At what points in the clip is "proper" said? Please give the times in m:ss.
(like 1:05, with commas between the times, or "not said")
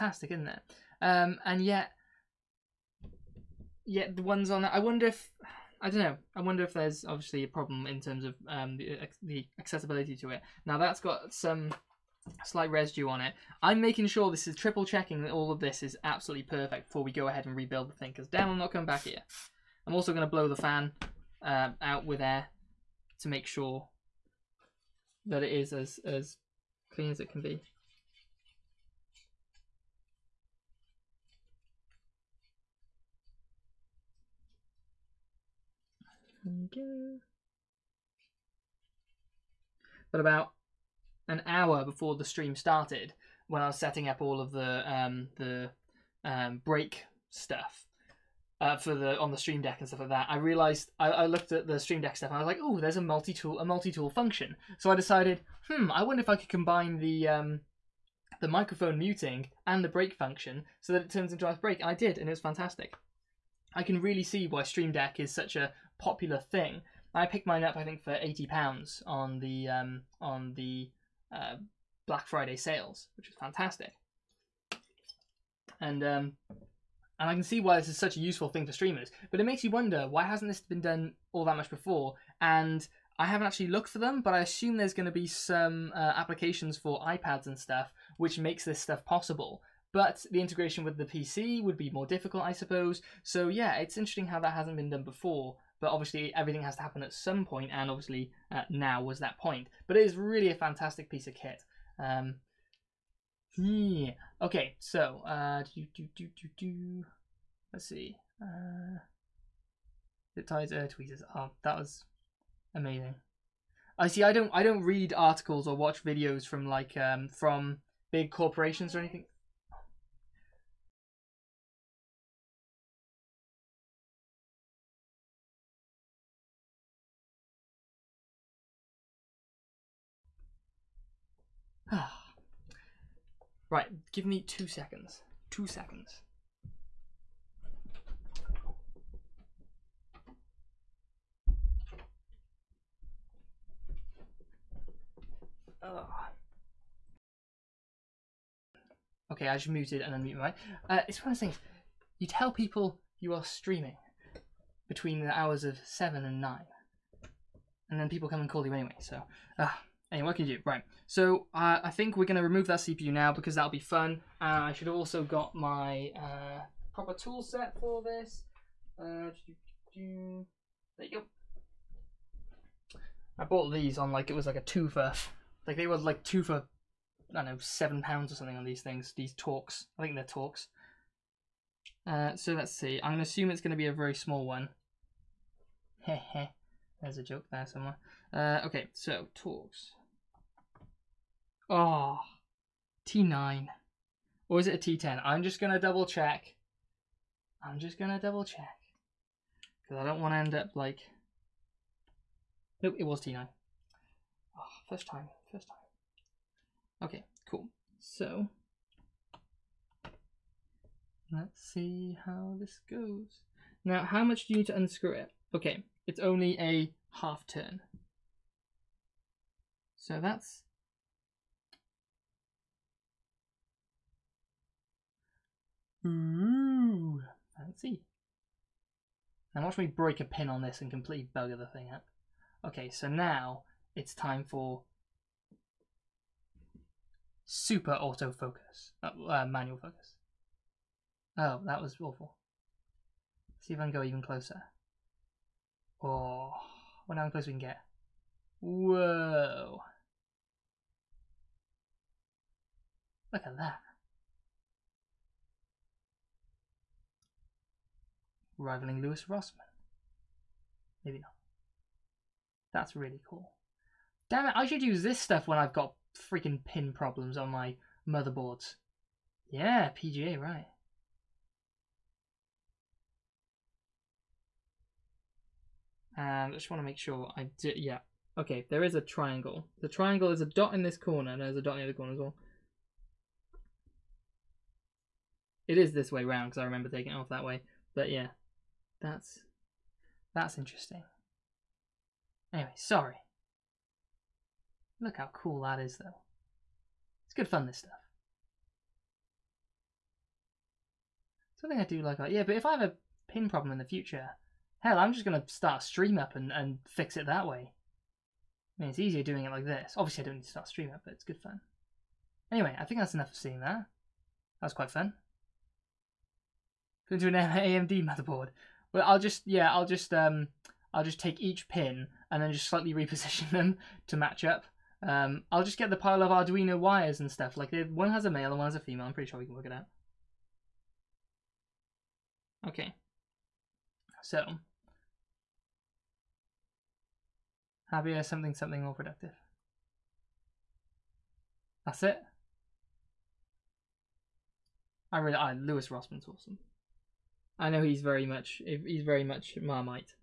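2:46.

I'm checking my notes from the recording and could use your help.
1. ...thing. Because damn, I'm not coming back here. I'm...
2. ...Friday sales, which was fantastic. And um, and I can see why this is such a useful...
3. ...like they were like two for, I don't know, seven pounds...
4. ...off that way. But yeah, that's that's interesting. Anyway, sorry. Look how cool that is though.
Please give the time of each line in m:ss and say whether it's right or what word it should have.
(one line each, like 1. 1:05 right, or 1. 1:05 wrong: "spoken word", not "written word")
1. 0:17 right
2. 1:12 right
3. 2:55 right
4. 4:47 right.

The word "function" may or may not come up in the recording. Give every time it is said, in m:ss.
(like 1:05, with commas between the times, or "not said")
0:54, 1:00.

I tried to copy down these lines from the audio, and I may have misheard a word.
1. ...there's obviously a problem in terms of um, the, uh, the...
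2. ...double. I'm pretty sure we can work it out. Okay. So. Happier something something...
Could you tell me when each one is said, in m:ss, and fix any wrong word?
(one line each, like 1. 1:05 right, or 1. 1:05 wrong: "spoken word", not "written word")
1. 0:06 right
2. 5:28 wrong: "female", not "double".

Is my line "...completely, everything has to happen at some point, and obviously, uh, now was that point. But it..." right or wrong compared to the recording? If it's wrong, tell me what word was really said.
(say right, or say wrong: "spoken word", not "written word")
wrong: "obviously", not "completely".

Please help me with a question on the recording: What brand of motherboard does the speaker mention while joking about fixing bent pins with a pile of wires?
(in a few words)
AMD.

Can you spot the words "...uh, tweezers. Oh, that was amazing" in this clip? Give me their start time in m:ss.
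1:50.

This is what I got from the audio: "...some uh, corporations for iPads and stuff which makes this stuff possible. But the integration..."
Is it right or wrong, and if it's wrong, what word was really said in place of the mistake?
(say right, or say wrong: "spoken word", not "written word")
wrong: "applications", not "corporations".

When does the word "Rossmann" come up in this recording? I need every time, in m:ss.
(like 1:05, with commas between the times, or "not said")
4:19, 5:45.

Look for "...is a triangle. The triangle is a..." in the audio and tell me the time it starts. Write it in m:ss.
4:38.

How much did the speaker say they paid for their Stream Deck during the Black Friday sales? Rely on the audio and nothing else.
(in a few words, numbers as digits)
80 pounds.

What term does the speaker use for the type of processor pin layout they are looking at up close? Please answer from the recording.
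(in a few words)
PGA.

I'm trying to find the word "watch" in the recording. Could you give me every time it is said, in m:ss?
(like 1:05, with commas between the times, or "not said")
1:55, 3:49.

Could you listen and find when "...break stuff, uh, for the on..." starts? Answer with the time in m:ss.
0:46.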